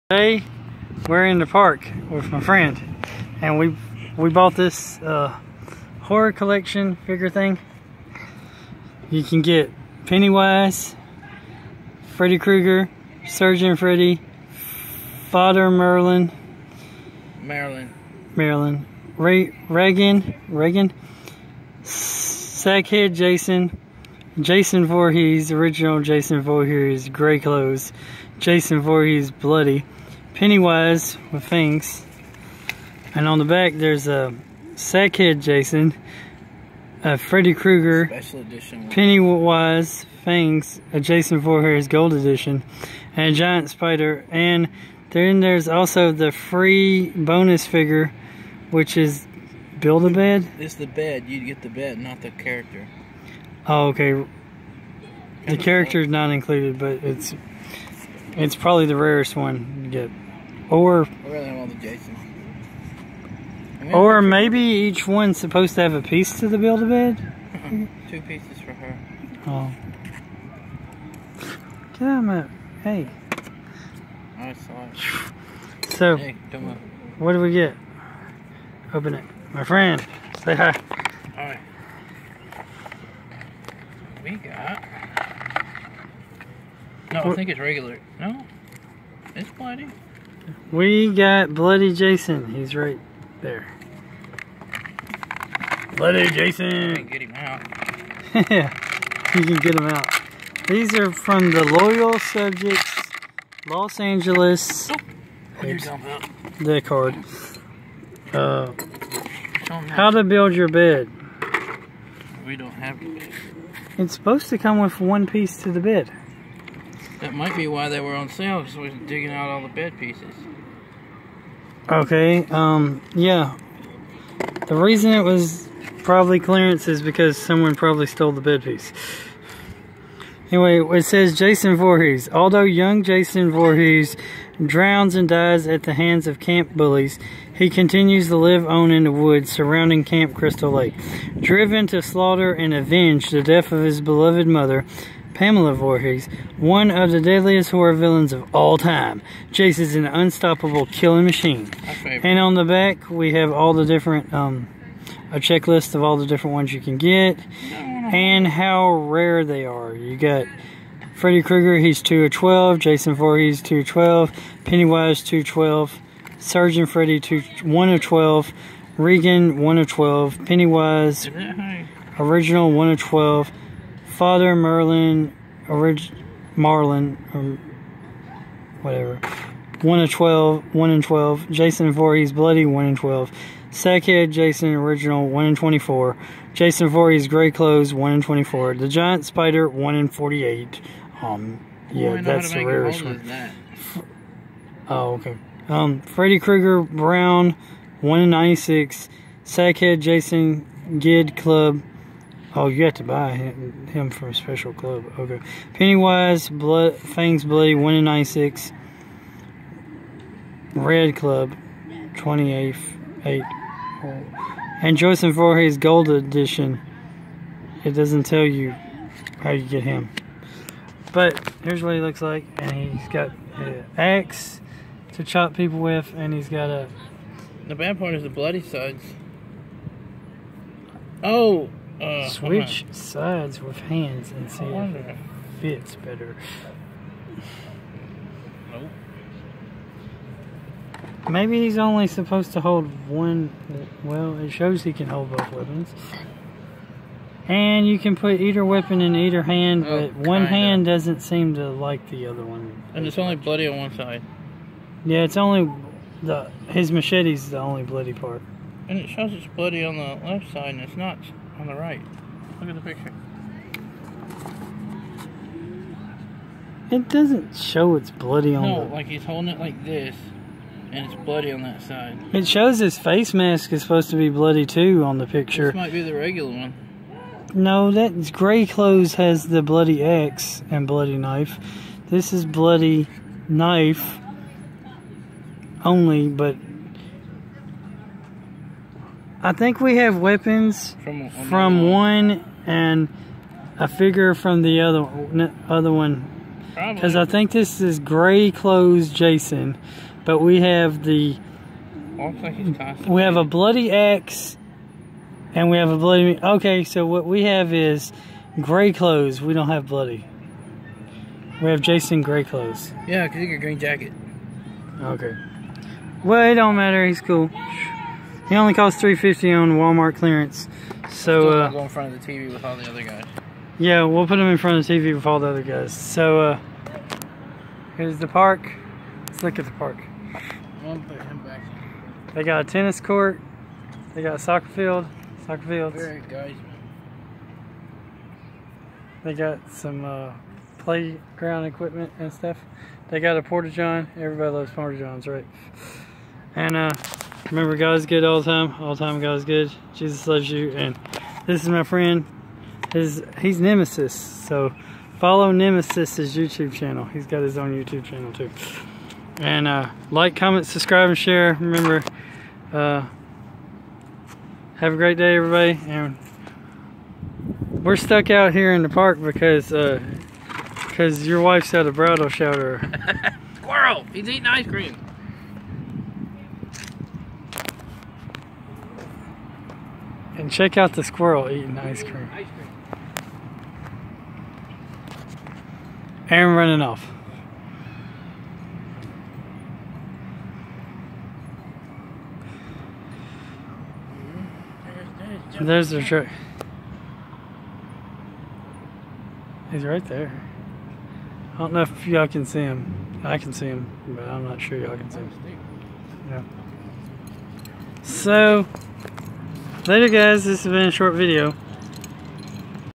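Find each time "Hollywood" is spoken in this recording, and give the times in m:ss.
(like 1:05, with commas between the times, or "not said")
not said.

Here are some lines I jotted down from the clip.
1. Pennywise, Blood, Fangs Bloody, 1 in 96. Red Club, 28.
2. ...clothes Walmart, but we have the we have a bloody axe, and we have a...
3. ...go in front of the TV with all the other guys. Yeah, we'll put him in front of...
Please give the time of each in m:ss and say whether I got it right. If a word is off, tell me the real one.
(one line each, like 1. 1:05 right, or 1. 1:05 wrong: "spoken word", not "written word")
1. 3:25 right
2. 4:58 wrong: "Jason", not "Walmart"
3. 5:21 right.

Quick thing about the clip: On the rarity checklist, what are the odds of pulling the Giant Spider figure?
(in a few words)
1 in 48.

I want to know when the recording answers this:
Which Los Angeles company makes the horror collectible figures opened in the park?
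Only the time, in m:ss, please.
1:41.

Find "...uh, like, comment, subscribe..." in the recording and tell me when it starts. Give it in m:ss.
5:59.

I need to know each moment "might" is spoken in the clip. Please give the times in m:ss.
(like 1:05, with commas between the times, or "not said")
1:57, 4:35.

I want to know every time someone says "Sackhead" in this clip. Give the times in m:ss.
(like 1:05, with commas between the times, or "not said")
0:21, 0:34, 3:03, 3:19.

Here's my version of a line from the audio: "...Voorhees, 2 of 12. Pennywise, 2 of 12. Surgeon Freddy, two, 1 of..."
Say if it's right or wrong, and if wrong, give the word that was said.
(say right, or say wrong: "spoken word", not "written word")
right.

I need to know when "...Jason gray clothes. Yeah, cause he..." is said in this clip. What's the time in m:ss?
5:11.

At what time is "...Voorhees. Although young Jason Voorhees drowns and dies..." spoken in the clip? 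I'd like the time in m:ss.
2:11.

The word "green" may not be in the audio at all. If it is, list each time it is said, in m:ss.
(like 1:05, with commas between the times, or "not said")
5:13.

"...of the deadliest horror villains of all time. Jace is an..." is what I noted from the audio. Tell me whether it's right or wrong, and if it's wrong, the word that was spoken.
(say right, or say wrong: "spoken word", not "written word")
right.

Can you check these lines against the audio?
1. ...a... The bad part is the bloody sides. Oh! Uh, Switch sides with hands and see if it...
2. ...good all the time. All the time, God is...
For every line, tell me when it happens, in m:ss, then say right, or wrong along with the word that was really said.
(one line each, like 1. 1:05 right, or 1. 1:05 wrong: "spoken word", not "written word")
1. 3:46 right
2. 5:48 right.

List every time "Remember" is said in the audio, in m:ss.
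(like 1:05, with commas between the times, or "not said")
5:47, 6:01.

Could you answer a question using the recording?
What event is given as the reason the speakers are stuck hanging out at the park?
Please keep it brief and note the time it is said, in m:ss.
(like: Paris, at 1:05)
A bridal shower, at 6:11.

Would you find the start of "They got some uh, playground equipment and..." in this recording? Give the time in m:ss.
5:39.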